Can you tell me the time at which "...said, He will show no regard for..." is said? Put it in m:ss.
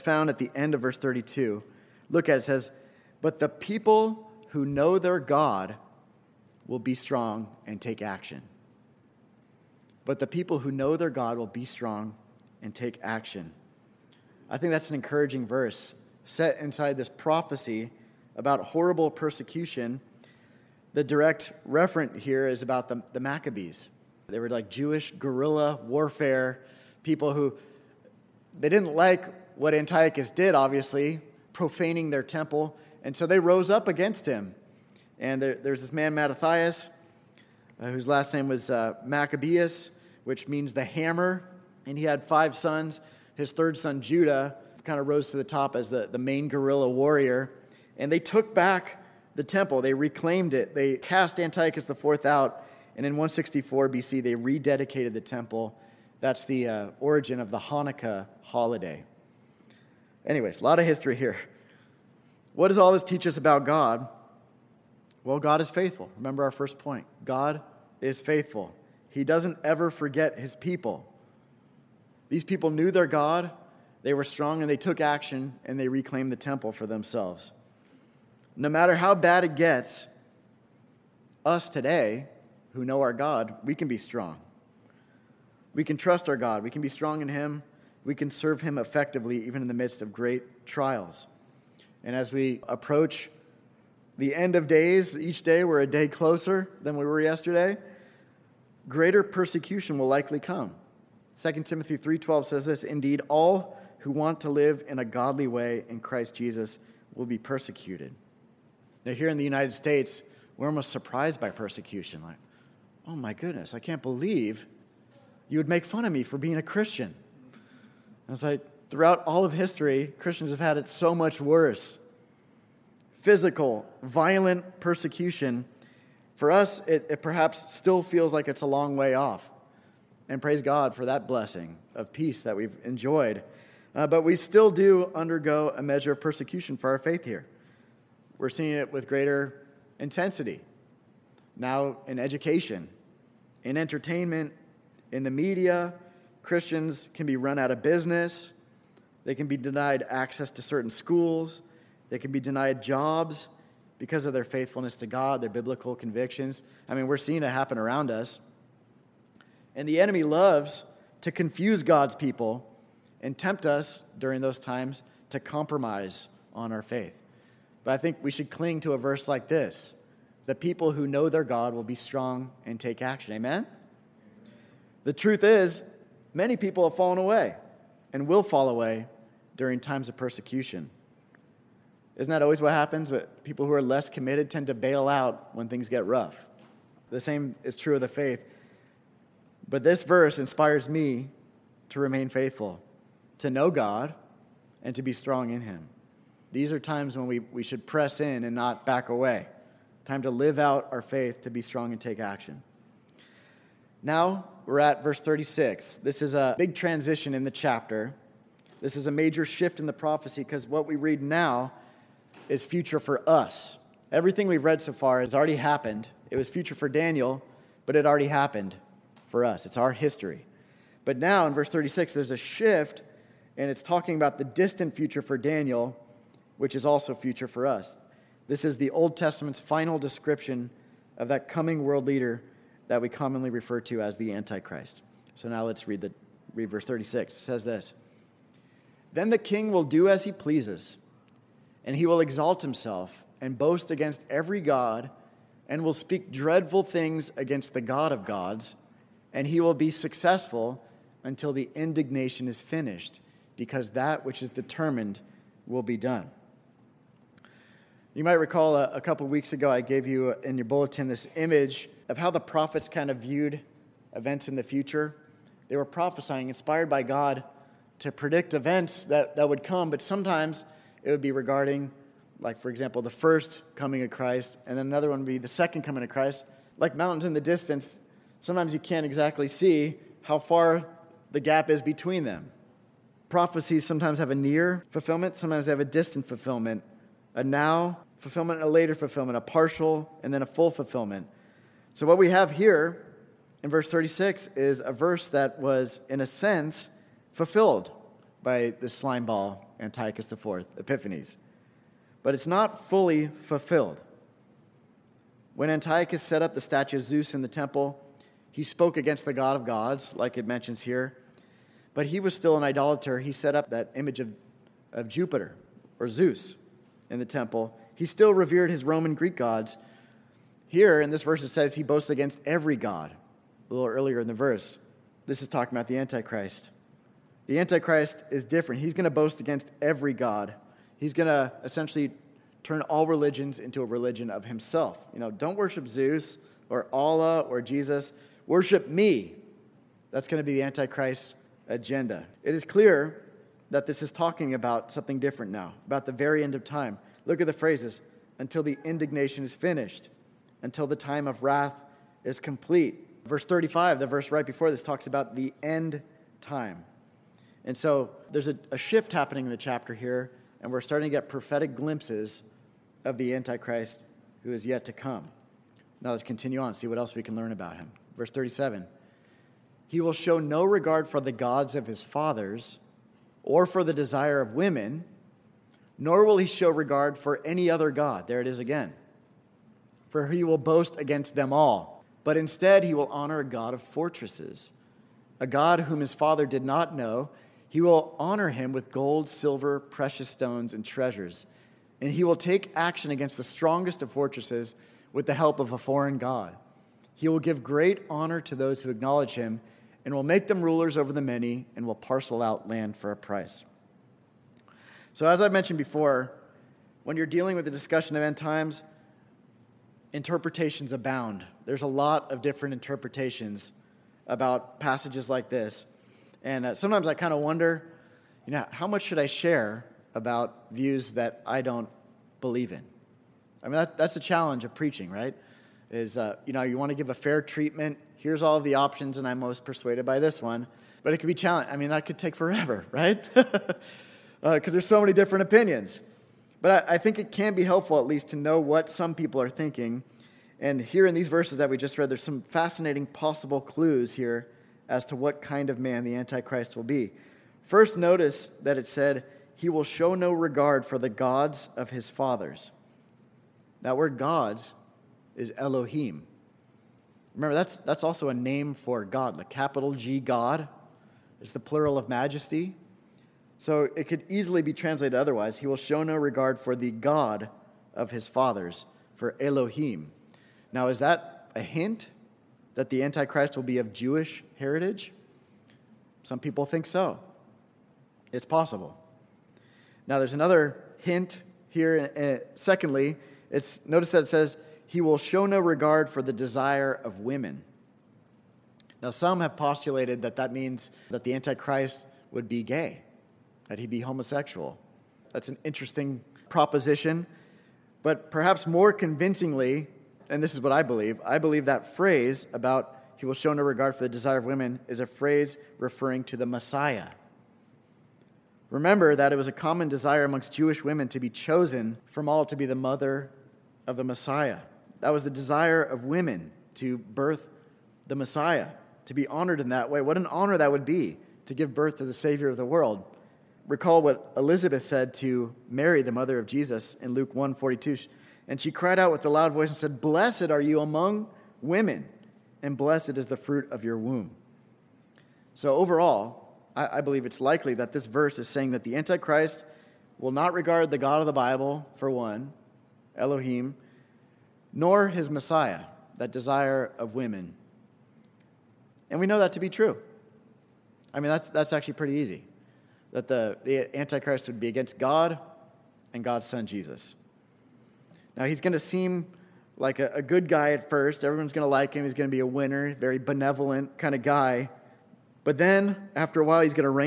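7:28.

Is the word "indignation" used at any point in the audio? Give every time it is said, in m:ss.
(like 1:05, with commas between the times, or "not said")
4:11, 5:48.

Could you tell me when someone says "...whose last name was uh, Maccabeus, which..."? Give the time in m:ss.
0:37.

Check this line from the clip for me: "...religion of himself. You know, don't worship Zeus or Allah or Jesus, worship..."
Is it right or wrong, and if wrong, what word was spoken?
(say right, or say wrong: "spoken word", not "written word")
right.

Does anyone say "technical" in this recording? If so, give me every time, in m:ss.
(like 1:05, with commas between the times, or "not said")
not said.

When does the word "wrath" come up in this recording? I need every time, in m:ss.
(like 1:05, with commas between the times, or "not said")
5:51.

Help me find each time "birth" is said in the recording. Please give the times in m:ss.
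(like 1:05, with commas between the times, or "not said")
8:36, 8:41.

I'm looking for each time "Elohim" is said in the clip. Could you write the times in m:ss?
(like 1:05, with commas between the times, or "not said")
7:35, 7:49, 9:03.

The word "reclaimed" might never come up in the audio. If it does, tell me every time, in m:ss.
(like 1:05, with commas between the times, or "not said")
0:49, 1:15.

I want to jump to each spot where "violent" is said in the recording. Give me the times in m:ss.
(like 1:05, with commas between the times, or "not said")
2:04.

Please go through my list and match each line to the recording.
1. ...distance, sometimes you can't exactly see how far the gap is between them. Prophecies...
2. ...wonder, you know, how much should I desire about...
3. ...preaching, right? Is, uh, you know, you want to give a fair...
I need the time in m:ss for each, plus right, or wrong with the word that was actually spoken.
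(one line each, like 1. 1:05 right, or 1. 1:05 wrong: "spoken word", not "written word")
1. 4:37 right
2. 6:57 wrong: "share", not "desire"
3. 7:04 right.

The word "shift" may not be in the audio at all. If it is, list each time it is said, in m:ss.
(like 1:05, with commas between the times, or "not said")
3:29, 3:42, 5:58.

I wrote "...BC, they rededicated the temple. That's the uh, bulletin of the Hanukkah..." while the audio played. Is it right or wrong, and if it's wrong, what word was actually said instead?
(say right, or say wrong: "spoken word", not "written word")
wrong: "origin", not "bulletin".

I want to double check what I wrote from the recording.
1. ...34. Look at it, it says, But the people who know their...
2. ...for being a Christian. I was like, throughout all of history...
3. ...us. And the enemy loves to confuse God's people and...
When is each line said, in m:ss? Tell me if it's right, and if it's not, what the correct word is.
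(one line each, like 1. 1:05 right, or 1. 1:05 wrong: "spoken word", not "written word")
1. 0:00 wrong: "32", not "34"
2. 1:56 right
3. 2:38 right.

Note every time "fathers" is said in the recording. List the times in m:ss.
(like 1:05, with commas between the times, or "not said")
6:12, 6:26, 7:32, 7:48.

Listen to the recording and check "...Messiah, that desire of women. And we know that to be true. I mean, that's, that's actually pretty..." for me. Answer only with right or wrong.
right.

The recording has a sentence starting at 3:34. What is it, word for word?
Everything we've read so far has already happened.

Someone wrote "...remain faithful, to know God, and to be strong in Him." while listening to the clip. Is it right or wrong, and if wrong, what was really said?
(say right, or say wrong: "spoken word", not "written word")
right.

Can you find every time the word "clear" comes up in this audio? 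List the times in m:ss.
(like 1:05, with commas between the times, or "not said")
5:42.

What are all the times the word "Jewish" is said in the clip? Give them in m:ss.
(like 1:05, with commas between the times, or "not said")
0:24, 7:53, 8:30.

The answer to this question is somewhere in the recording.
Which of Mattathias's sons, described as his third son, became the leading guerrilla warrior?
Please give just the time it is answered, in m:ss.
0:44.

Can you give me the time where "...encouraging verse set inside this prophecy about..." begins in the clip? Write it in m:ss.
0:14.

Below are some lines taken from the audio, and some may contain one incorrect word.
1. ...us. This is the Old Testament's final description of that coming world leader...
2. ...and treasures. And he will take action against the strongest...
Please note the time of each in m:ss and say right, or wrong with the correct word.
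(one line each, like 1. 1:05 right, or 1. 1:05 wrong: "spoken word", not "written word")
1. 3:47 right
2. 6:30 right.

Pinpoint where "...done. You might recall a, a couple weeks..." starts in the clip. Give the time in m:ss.
4:15.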